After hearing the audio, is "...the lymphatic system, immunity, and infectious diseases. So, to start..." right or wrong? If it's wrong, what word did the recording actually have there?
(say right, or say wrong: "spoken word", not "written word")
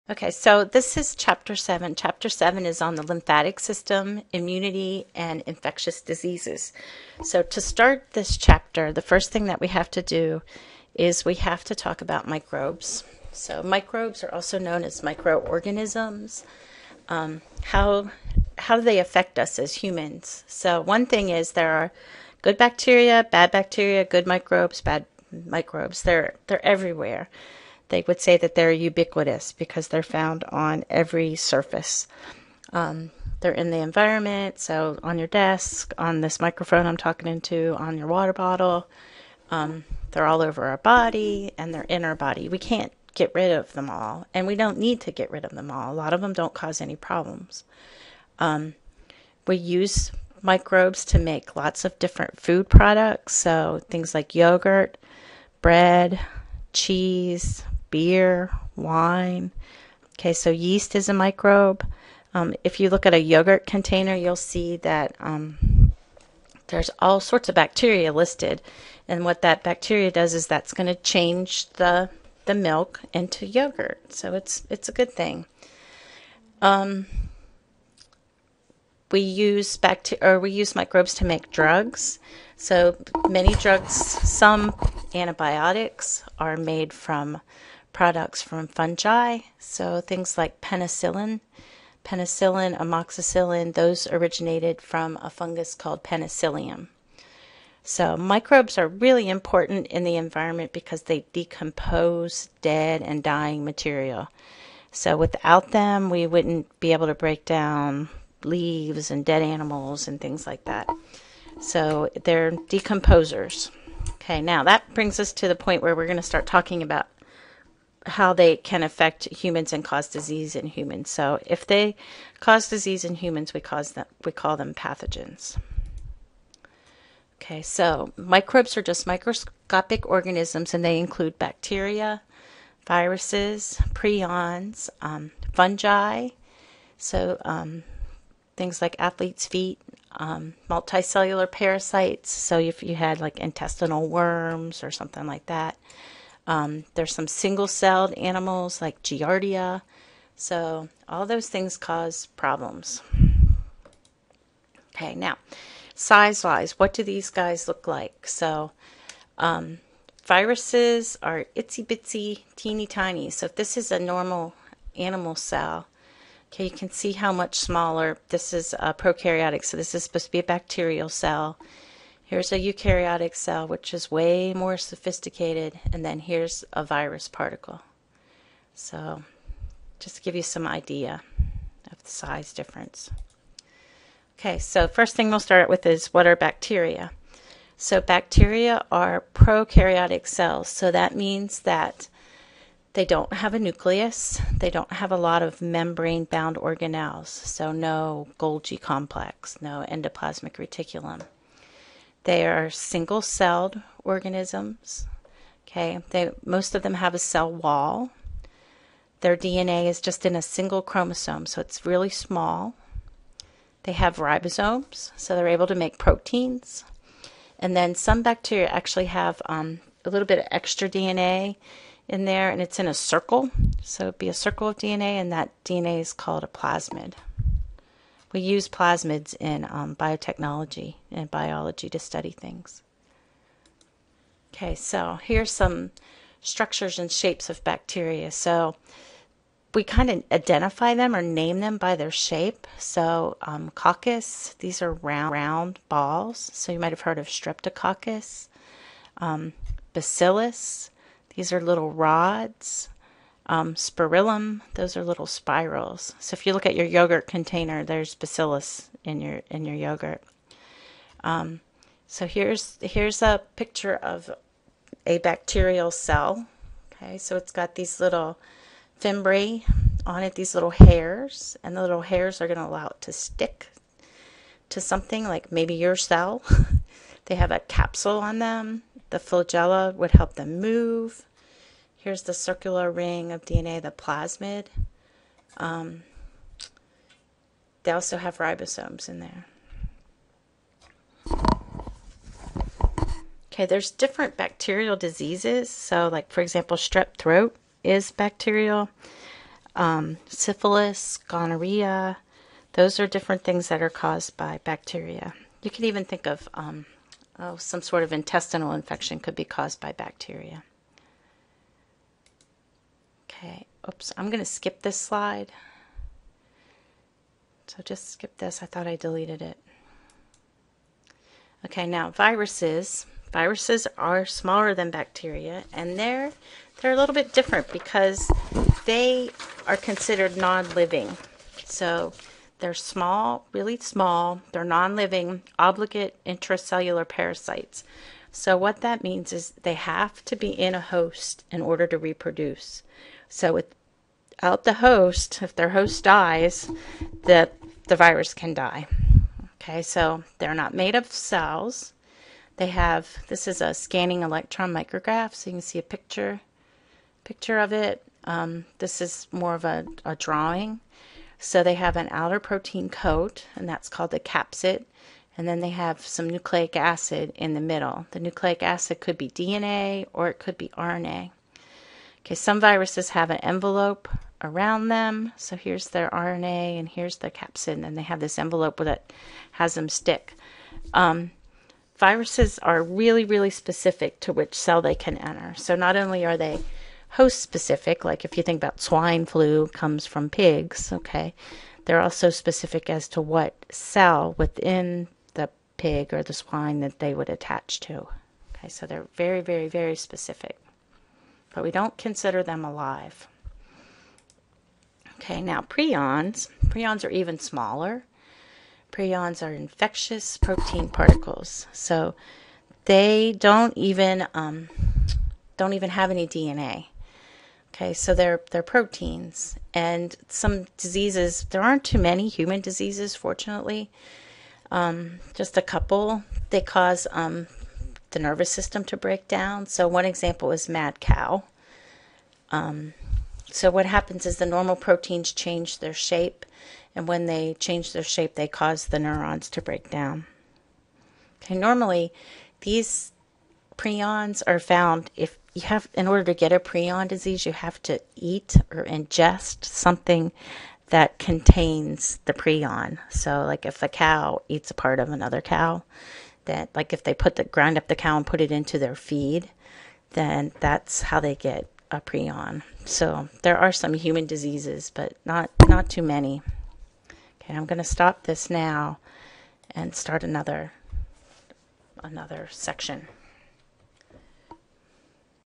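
right.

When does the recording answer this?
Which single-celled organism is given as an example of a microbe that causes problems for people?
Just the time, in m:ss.
2:29.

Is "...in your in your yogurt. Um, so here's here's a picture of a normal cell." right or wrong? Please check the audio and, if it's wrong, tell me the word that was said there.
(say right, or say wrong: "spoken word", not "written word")
wrong: "bacterial", not "normal".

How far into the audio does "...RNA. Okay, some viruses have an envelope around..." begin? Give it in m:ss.
6:10.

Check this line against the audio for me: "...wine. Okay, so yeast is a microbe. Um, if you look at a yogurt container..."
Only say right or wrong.
right.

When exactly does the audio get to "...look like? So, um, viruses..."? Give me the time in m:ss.
2:37.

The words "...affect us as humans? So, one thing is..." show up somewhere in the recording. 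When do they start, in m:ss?
0:18.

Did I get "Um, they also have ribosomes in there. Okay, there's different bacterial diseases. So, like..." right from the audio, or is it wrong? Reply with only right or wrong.
right.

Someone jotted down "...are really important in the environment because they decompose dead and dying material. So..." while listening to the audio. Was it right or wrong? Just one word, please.
right.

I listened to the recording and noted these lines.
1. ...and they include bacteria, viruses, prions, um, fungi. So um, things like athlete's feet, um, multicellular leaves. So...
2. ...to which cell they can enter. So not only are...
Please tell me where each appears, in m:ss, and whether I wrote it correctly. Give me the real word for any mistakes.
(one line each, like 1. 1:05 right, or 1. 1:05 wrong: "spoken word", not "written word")
1. 2:10 wrong: "parasites", not "leaves"
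2. 6:24 right.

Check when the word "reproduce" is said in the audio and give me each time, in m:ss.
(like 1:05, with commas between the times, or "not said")
5:41.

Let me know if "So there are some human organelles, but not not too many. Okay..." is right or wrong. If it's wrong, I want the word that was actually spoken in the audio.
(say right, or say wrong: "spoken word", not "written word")
wrong: "diseases", not "organelles".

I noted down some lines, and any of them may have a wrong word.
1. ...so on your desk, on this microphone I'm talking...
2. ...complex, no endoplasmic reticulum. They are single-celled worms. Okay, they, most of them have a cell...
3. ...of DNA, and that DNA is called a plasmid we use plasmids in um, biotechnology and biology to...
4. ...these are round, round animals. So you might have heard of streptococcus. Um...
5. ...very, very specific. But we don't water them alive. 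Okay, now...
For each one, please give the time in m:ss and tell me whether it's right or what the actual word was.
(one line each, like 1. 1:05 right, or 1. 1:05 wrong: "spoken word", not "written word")
1. 0:34 right
2. 3:18 wrong: "organisms", not "worms"
3. 3:44 right
4. 4:04 wrong: "balls", not "animals"
5. 6:39 wrong: "consider", not "water".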